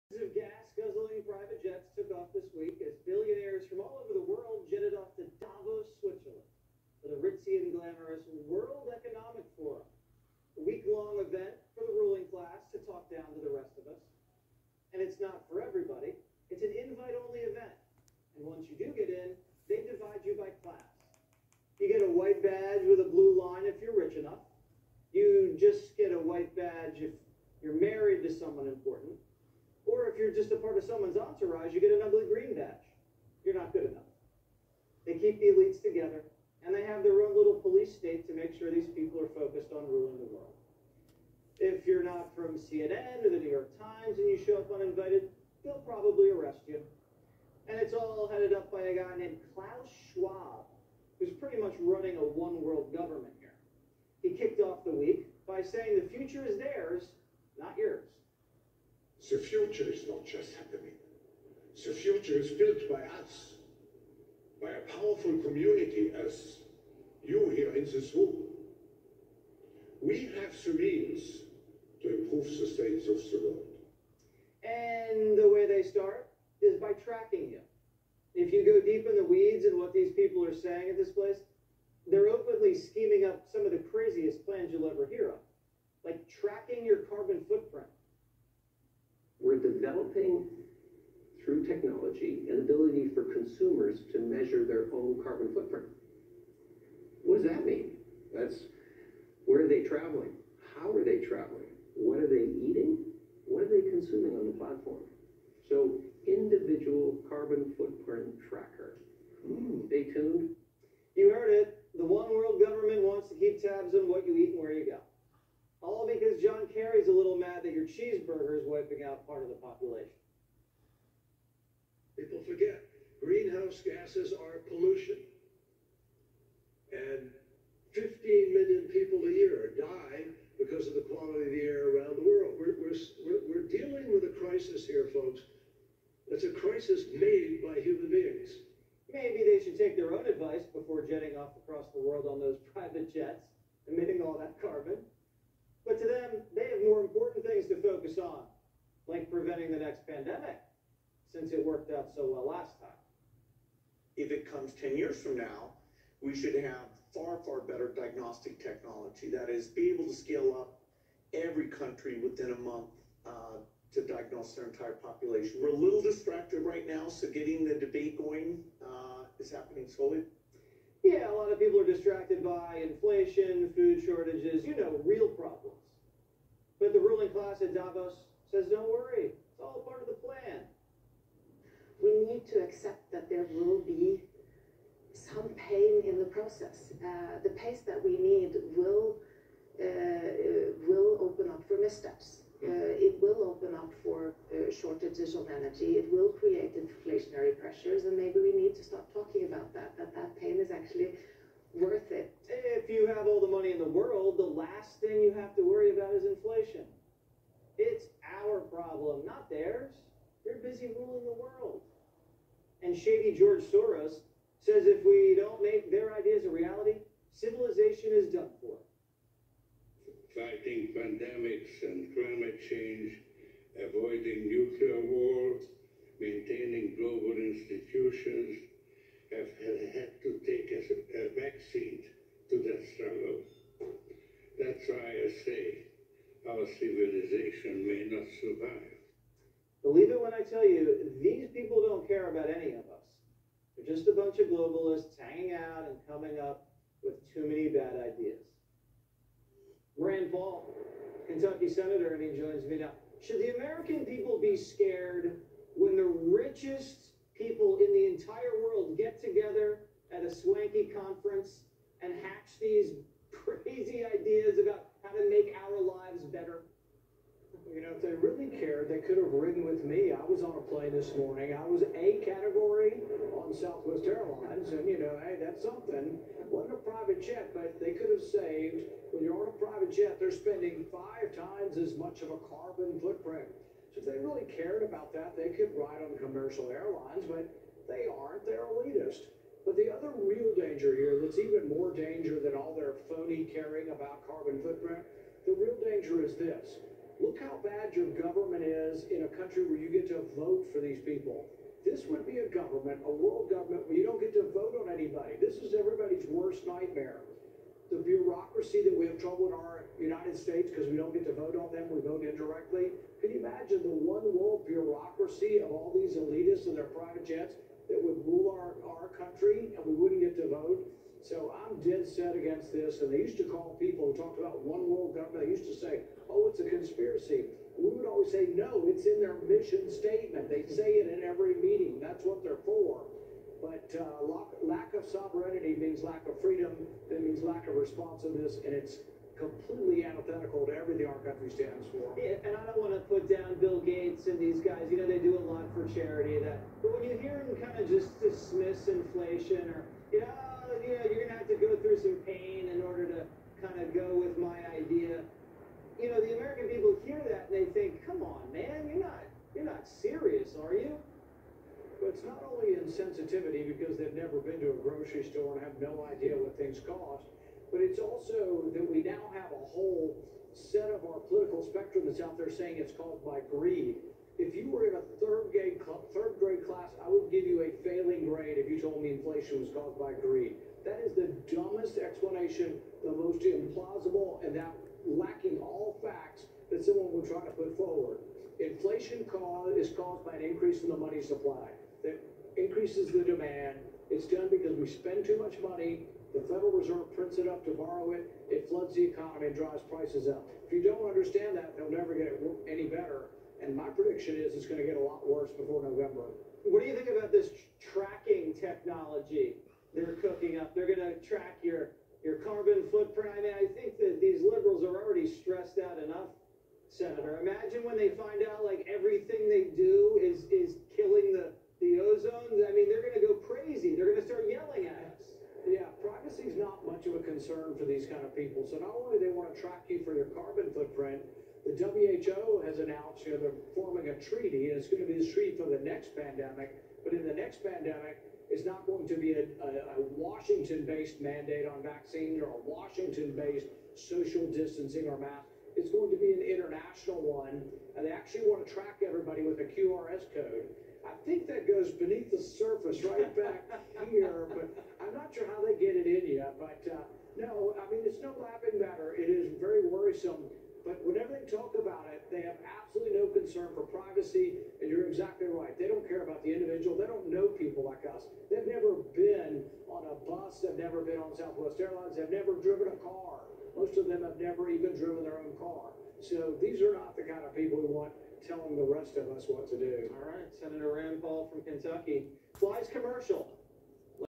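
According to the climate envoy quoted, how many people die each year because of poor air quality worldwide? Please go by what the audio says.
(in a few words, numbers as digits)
15 million.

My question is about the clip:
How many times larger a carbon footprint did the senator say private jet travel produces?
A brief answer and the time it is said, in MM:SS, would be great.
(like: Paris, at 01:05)
5, at 04:40.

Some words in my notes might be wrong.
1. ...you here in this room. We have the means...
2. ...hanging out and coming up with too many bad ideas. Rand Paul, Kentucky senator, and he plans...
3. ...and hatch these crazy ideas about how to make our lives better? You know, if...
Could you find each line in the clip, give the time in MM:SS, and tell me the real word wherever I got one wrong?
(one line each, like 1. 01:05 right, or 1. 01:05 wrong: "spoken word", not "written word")
1. 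01:07 right
2. 04:05 wrong: "joins", not "plans"
3. 04:22 right.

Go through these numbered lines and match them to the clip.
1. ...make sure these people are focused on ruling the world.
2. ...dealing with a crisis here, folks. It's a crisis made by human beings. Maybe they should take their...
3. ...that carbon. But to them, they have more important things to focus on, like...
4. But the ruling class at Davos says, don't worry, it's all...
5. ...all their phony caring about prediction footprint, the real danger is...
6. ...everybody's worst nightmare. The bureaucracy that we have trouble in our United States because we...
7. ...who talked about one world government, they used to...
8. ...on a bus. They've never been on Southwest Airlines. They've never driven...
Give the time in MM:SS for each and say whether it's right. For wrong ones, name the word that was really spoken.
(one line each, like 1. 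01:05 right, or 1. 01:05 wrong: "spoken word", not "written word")
1. 00:38 right
2. 02:13 right
3. 02:24 right
4. 02:56 right
5. 04:52 wrong: "carbon", not "prediction"
6. 05:05 right
7. 05:24 right
8. 07:49 right.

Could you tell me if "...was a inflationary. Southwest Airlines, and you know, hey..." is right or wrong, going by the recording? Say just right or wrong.
wrong.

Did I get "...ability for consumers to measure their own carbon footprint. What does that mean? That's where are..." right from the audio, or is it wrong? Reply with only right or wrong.
right.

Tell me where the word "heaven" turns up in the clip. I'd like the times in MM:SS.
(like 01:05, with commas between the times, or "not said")
not said.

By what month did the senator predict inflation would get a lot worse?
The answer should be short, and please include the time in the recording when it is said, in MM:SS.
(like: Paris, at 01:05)
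November, at 06:45.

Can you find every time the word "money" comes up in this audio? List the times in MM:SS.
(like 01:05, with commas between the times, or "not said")
03:23, 06:30, 06:35.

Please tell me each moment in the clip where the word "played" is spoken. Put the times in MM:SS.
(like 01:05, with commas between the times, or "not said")
not said.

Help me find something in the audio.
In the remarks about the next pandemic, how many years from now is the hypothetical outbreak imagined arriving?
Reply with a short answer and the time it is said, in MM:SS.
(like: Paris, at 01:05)
10, at 02:34.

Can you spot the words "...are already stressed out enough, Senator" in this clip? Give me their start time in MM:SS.
06:54.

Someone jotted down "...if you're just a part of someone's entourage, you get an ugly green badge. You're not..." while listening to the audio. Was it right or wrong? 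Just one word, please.
right.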